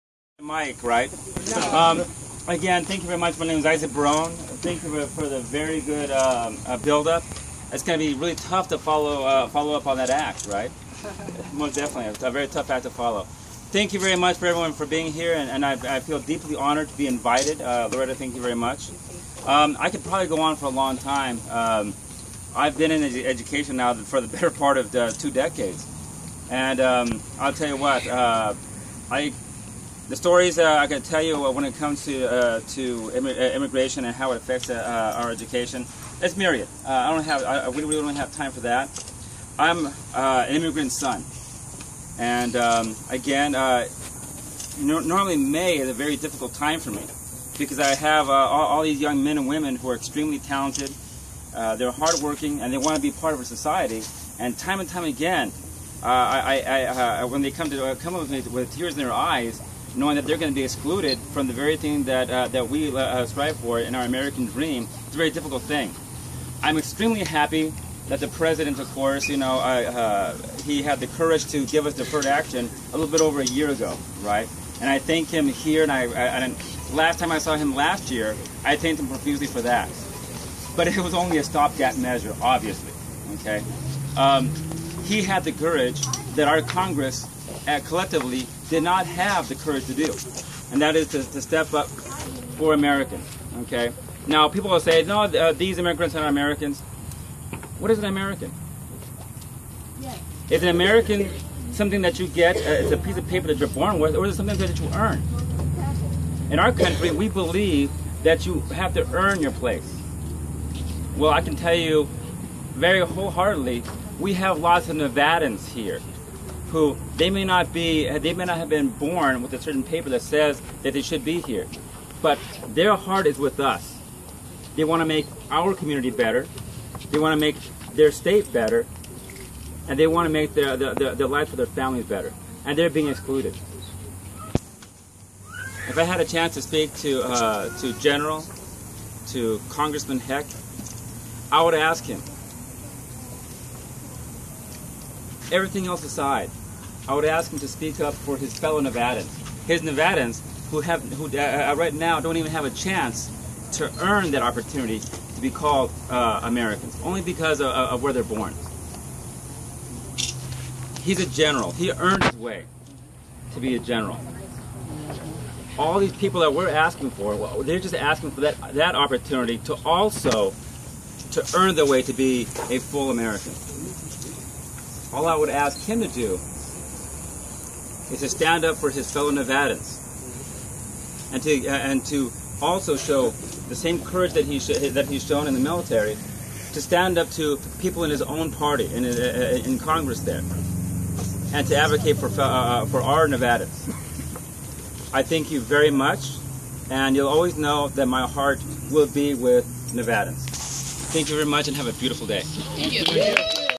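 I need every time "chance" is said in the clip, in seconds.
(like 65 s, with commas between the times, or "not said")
136 s, 152 s.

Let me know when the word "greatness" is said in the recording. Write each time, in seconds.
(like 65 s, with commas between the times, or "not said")
not said.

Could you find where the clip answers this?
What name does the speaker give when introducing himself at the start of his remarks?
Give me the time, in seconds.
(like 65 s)
3 s.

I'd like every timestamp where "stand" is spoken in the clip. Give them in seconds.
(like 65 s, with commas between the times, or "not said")
178 s, 186 s.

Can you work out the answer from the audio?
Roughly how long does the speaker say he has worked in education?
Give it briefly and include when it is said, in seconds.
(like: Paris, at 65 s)
Two decades, at 25 s.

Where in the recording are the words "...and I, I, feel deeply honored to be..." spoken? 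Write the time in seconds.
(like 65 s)
15 s.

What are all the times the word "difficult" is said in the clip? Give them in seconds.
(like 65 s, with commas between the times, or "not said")
46 s, 65 s.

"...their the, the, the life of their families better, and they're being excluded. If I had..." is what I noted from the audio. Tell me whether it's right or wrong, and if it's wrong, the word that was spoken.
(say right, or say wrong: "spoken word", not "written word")
right.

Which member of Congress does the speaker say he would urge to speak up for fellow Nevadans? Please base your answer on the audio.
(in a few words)
Congressman Heck.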